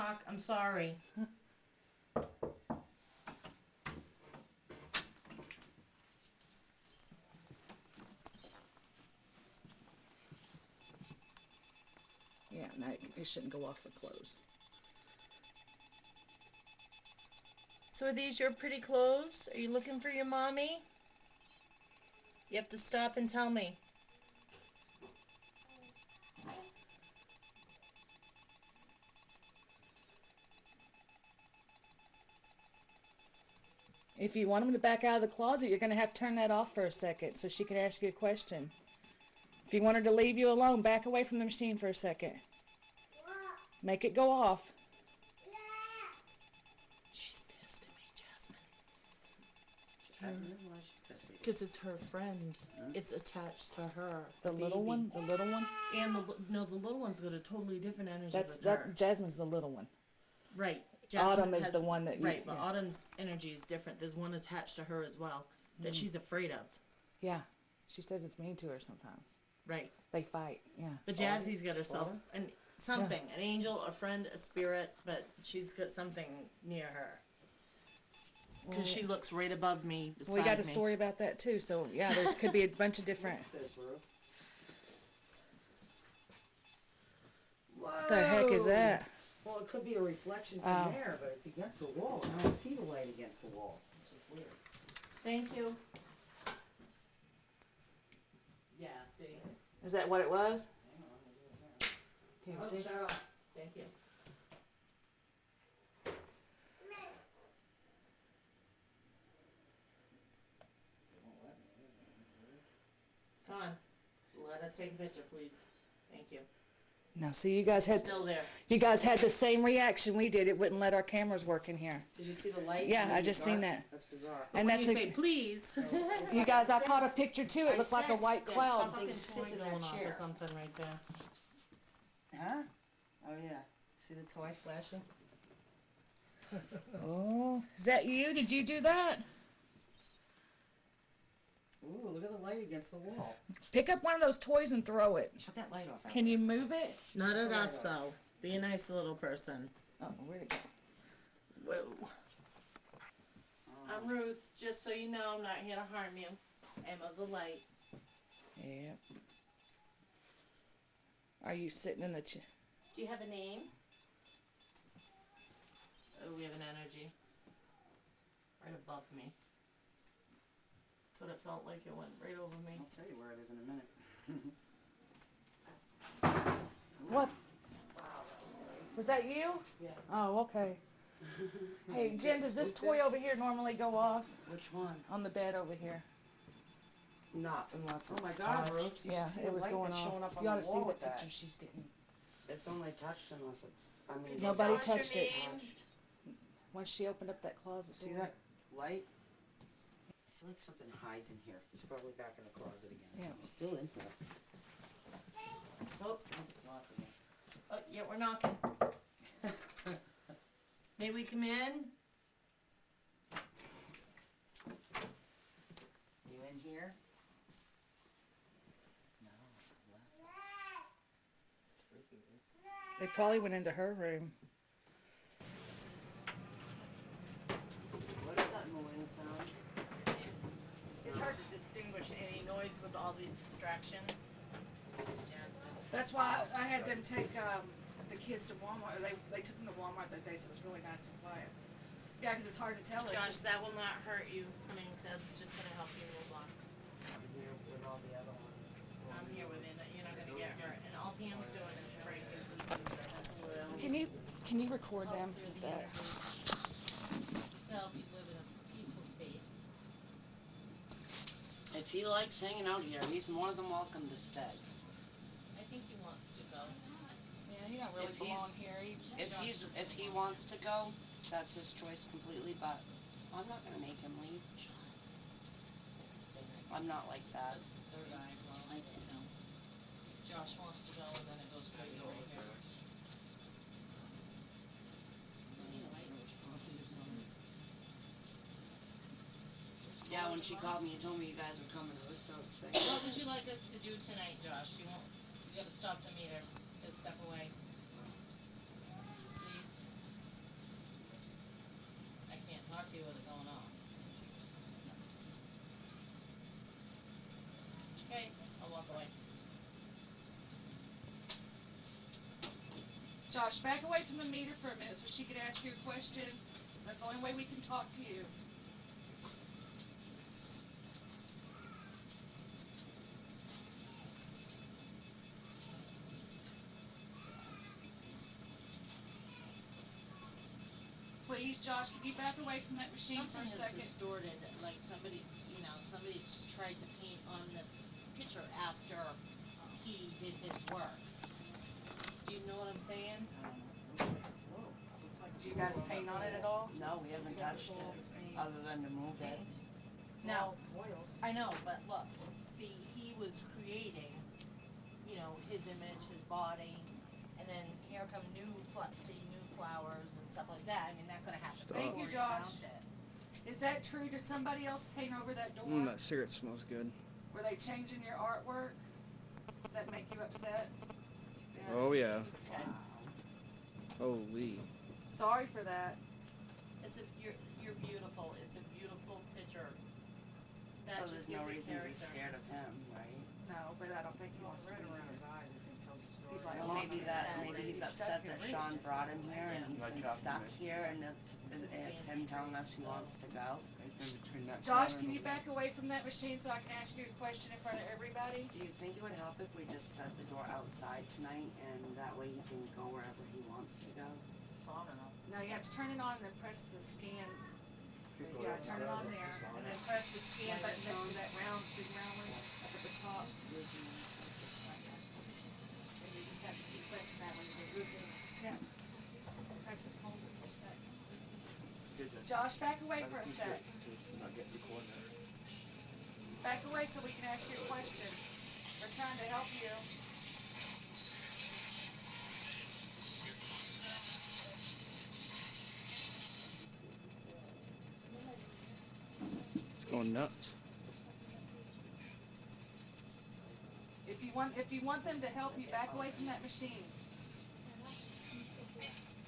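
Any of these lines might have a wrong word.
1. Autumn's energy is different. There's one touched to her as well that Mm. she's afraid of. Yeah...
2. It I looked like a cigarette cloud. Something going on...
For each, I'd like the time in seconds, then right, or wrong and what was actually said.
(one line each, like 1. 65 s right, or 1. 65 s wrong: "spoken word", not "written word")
1. 62 s wrong: "attached", not "touched"
2. 127 s wrong: "white", not "cigarette".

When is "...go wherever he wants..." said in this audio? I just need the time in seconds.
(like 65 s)
402 s.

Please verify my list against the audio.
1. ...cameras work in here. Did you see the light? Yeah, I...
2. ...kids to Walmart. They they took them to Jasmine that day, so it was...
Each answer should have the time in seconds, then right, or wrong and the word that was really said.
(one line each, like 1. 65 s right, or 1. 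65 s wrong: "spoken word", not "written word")
1. 121 s right
2. 238 s wrong: "Walmart", not "Jasmine".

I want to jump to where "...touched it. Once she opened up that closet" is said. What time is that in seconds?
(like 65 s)
194 s.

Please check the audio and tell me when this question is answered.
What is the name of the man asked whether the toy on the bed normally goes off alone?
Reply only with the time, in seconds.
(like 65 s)
181 s.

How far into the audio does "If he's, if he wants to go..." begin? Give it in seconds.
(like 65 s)
269 s.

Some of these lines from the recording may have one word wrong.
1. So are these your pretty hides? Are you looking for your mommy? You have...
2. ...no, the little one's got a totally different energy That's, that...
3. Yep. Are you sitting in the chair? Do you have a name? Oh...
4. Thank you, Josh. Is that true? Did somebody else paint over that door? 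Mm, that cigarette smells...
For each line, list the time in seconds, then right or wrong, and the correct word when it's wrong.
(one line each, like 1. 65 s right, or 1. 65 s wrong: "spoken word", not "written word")
1. 17 s wrong: "clothes", not "hides"
2. 56 s right
3. 158 s right
4. 361 s right.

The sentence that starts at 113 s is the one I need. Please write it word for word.
Come on, let us take a picture, please.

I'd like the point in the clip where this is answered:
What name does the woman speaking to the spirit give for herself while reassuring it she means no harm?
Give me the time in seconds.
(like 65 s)
153 s.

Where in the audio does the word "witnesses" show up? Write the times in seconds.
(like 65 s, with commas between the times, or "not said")
not said.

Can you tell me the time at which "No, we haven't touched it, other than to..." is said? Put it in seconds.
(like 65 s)
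346 s.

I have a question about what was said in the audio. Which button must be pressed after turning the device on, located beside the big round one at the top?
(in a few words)
scan button.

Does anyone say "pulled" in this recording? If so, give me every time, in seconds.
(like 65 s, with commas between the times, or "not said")
not said.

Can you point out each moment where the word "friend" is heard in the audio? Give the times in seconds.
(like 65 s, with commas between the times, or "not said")
52 s, 73 s.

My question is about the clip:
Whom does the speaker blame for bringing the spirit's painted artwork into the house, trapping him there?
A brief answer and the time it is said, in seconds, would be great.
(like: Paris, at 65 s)
Sean, at 388 s.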